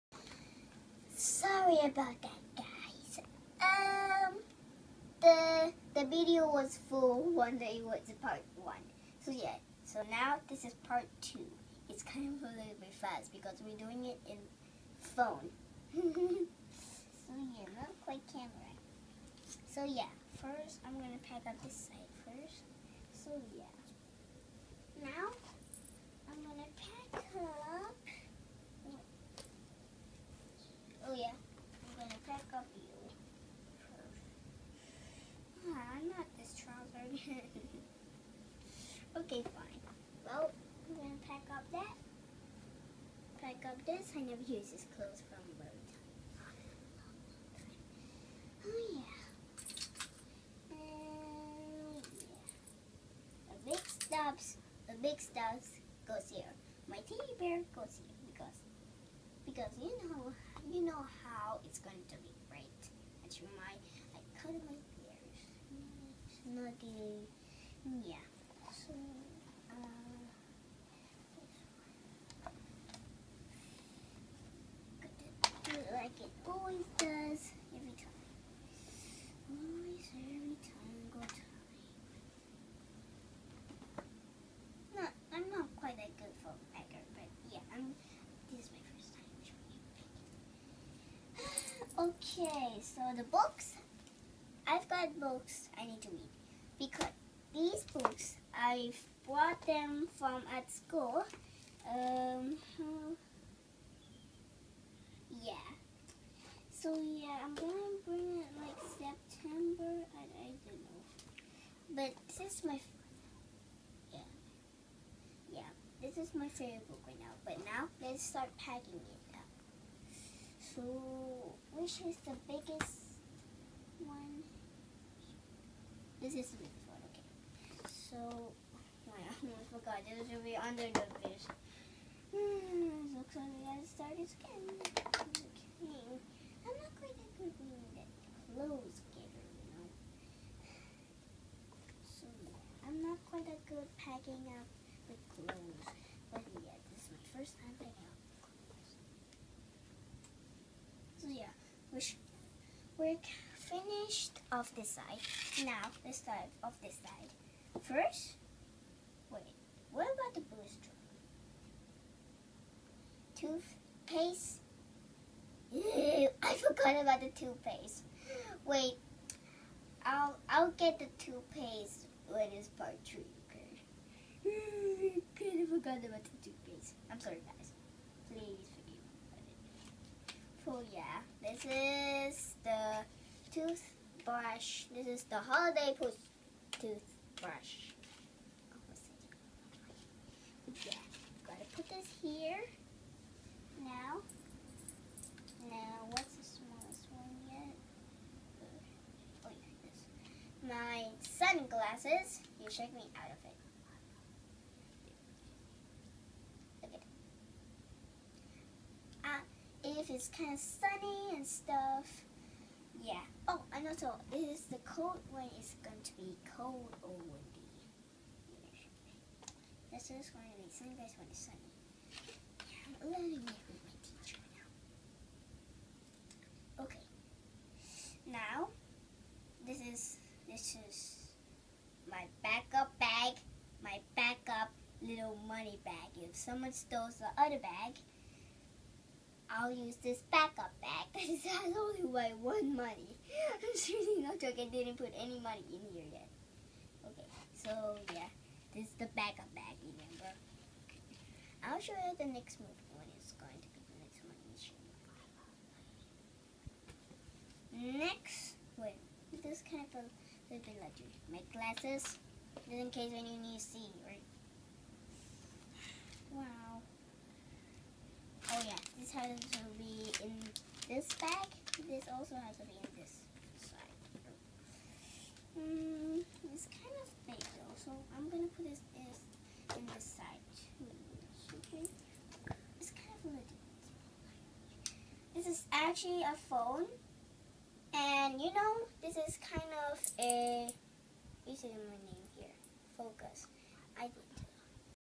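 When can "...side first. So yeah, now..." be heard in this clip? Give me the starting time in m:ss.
0:21.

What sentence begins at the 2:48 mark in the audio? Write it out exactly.
Wait, I'll I'll get the toothpaste when it's part three.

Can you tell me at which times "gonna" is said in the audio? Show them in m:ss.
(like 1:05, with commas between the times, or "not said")
0:20, 0:26, 1:47, 4:38.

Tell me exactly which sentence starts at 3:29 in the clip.
Uh, if it's kind of sunny and stuff, yeah.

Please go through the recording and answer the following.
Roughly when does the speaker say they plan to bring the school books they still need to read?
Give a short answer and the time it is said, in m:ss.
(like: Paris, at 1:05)
September, at 1:48.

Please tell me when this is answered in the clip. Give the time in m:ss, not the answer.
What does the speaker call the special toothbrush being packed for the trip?
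3:05.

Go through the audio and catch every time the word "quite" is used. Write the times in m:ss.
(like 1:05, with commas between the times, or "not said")
0:18, 1:25, 2:23.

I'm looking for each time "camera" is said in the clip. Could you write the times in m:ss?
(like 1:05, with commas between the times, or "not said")
0:18.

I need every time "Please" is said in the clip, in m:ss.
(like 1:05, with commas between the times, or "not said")
2:58.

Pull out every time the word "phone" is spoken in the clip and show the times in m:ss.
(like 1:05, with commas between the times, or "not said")
0:15, 4:46.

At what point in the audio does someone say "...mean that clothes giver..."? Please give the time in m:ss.
2:17.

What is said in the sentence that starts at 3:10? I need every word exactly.
Yeah, gotta put this here now.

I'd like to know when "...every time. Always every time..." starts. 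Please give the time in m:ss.
1:17.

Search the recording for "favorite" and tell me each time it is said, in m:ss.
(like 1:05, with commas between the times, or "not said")
1:56.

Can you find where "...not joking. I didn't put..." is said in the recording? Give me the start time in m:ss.
4:04.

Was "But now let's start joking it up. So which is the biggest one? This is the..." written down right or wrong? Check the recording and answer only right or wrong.
wrong.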